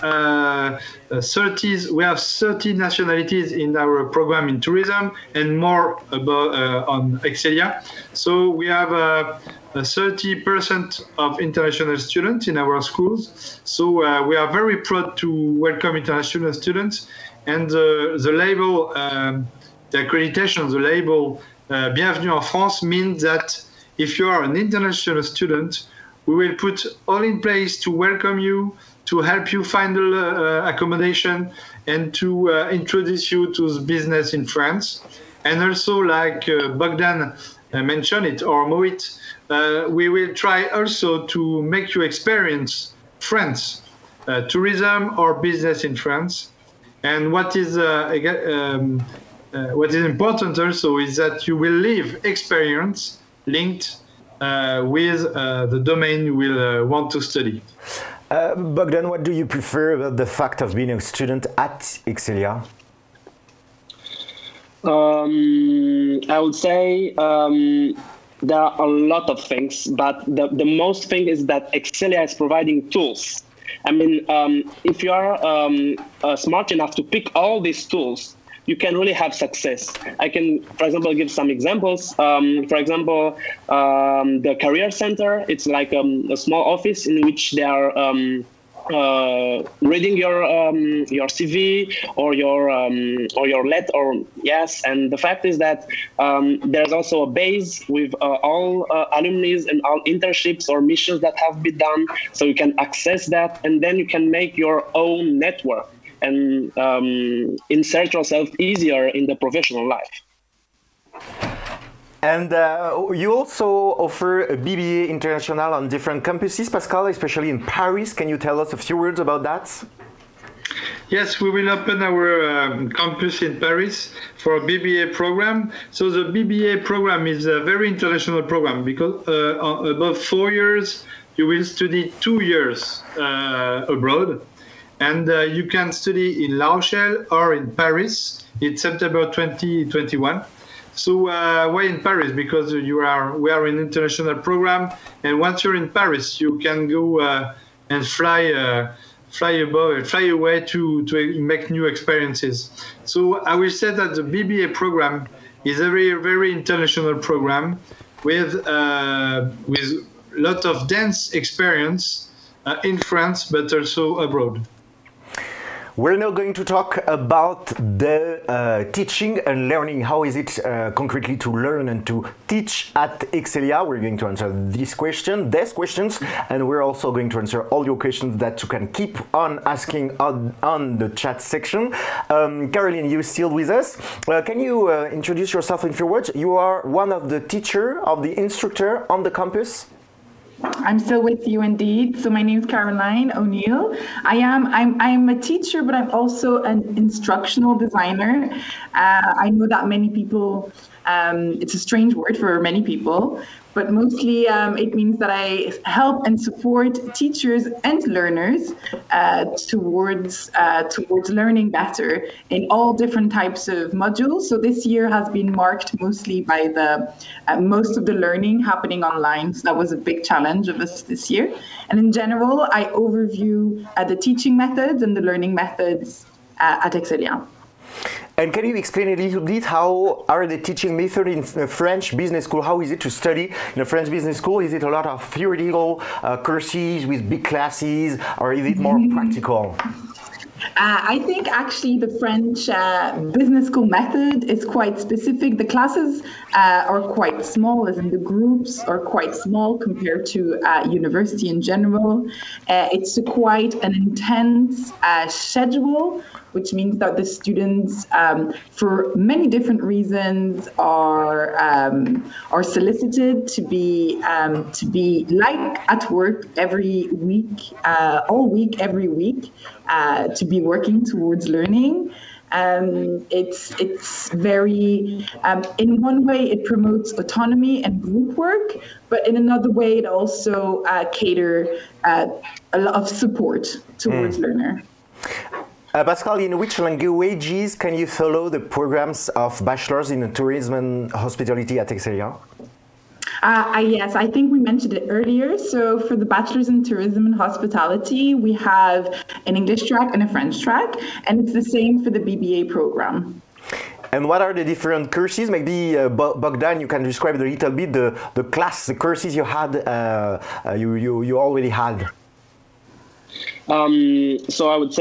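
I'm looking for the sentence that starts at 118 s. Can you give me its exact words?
Can you tell us a few words about that?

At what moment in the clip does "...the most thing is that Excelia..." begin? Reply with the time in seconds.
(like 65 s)
70 s.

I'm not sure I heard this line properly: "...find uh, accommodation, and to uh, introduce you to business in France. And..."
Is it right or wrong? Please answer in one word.
right.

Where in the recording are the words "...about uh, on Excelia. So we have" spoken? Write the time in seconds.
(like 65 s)
6 s.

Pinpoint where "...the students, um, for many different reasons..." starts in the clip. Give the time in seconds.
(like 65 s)
257 s.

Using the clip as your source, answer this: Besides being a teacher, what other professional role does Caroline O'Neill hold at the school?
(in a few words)
Instructional designer.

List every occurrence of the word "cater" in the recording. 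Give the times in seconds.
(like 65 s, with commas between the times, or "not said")
281 s.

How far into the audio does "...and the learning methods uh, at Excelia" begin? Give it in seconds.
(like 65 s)
225 s.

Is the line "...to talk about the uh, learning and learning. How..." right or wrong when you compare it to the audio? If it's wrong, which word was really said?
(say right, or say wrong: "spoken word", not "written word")
wrong: "teaching", not "learning".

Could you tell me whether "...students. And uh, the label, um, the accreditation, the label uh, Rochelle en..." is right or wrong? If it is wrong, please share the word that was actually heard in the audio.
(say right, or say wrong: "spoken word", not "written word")
wrong: "Bienvenue", not "Rochelle".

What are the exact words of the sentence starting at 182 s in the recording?
Um, Caroline, you still with us?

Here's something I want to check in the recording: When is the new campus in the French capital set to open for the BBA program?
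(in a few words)
September 2021.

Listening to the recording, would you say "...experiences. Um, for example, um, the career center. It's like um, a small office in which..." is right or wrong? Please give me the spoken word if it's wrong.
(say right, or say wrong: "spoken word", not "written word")
wrong: "examples", not "experiences".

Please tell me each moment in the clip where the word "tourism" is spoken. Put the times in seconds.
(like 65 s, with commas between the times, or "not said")
4 s, 44 s, 290 s, 296 s.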